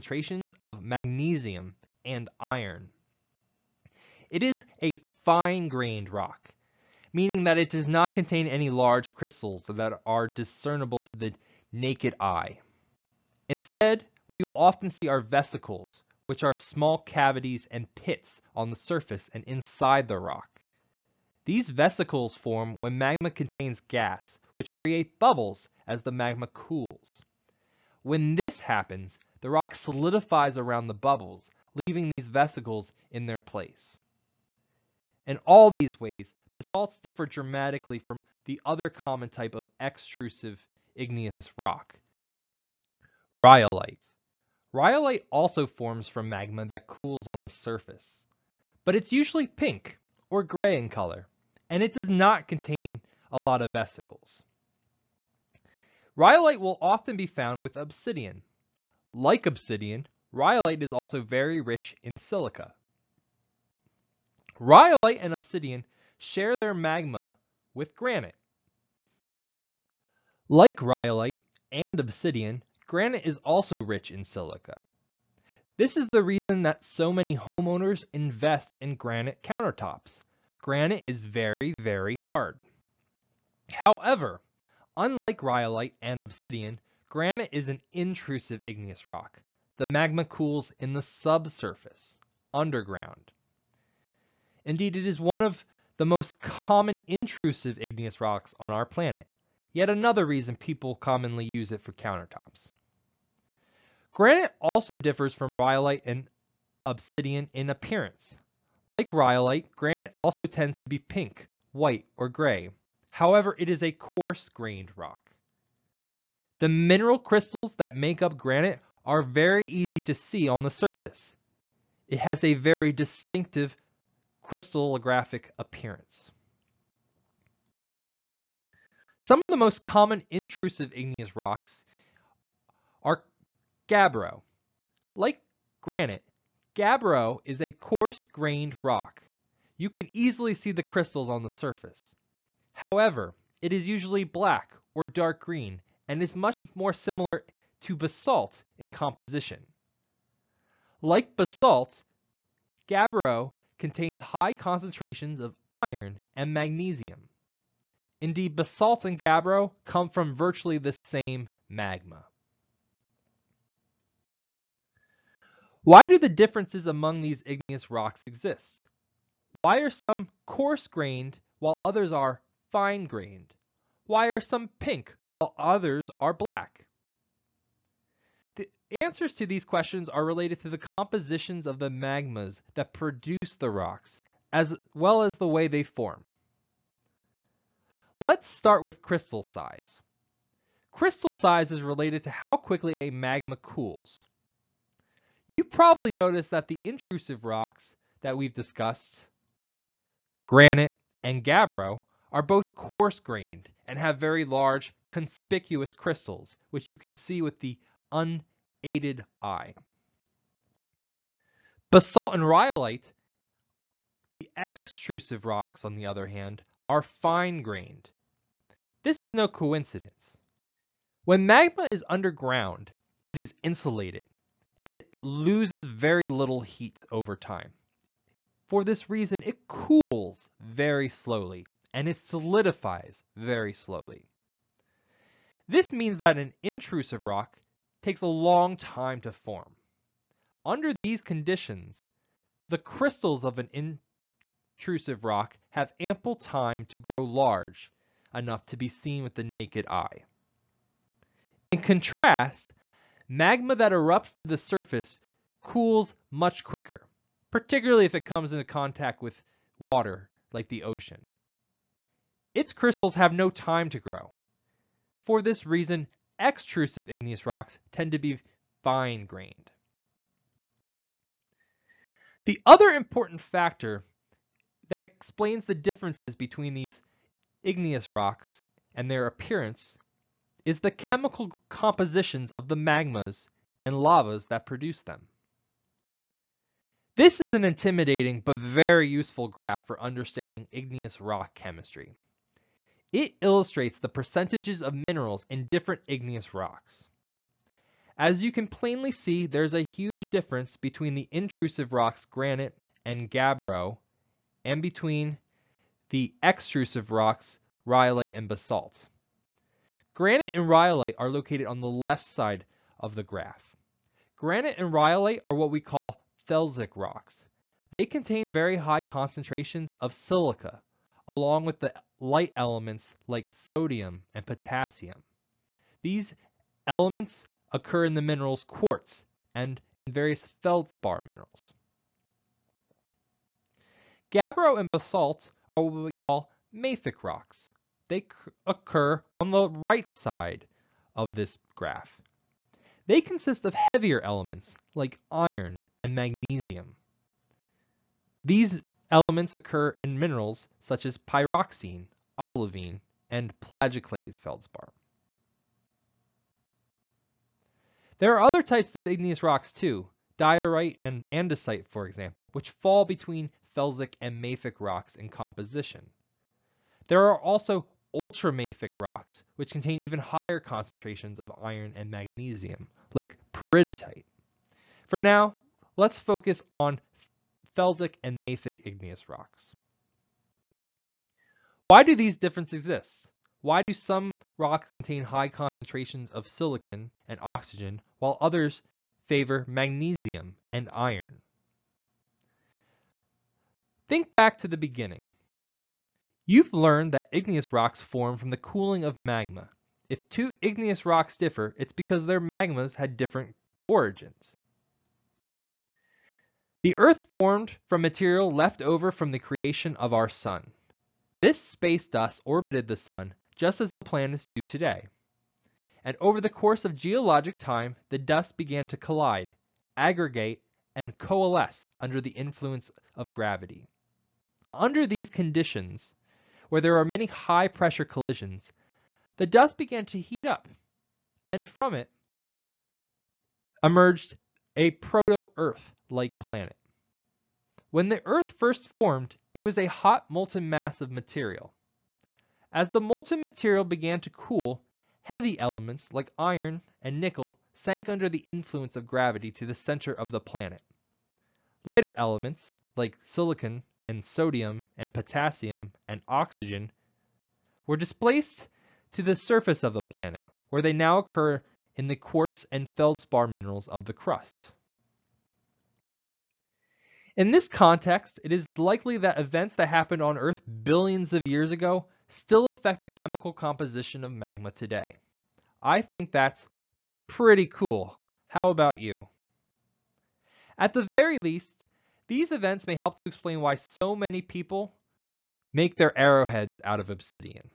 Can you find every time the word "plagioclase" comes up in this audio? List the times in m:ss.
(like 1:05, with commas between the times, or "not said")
5:53.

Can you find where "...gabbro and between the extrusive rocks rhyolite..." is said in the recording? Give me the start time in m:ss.
5:03.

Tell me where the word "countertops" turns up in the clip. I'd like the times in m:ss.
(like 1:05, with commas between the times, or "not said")
1:19, 1:41.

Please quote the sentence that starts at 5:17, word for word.
They contain very high concentrations of silica, along with the light elements like sodium and potassium.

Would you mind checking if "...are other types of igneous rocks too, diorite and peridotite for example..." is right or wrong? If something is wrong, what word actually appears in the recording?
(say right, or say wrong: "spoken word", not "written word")
wrong: "andesite", not "peridotite".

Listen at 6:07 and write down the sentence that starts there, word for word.
There are also ultramafic rocks, which contain even higher concentrations of iron and magnesium, like peridotite.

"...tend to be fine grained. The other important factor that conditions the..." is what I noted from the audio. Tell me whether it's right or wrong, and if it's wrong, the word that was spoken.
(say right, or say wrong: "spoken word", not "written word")
wrong: "explains", not "conditions".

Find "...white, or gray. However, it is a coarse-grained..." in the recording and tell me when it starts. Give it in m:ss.
1:51.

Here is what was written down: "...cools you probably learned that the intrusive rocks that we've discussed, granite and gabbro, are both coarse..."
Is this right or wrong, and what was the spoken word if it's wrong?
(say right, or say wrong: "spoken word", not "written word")
wrong: "noticed", not "learned".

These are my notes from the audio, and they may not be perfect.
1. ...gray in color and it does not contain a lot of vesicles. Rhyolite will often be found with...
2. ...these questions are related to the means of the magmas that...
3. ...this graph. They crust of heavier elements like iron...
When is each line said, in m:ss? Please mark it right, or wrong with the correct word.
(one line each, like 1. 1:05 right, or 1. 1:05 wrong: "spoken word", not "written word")
1. 0:50 right
2. 2:59 wrong: "compositions", not "means"
3. 5:41 wrong: "consist", not "crust".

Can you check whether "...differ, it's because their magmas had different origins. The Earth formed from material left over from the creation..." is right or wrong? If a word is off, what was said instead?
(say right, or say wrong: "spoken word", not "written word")
right.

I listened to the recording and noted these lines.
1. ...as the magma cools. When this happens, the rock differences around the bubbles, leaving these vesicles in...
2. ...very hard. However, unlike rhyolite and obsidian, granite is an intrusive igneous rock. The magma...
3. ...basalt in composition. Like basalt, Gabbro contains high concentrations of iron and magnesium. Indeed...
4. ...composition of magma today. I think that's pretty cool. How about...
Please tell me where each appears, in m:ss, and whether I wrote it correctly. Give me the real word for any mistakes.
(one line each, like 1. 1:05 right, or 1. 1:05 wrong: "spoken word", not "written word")
1. 0:25 wrong: "solidifies", not "differences"
2. 1:21 right
3. 2:27 right
4. 7:53 right.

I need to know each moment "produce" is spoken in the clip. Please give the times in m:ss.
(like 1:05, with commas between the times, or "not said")
3:02, 4:44.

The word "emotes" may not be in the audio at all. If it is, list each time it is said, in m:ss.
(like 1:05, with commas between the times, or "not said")
not said.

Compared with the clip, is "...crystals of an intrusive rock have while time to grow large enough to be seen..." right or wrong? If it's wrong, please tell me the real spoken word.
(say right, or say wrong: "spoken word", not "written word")
wrong: "ample", not "while".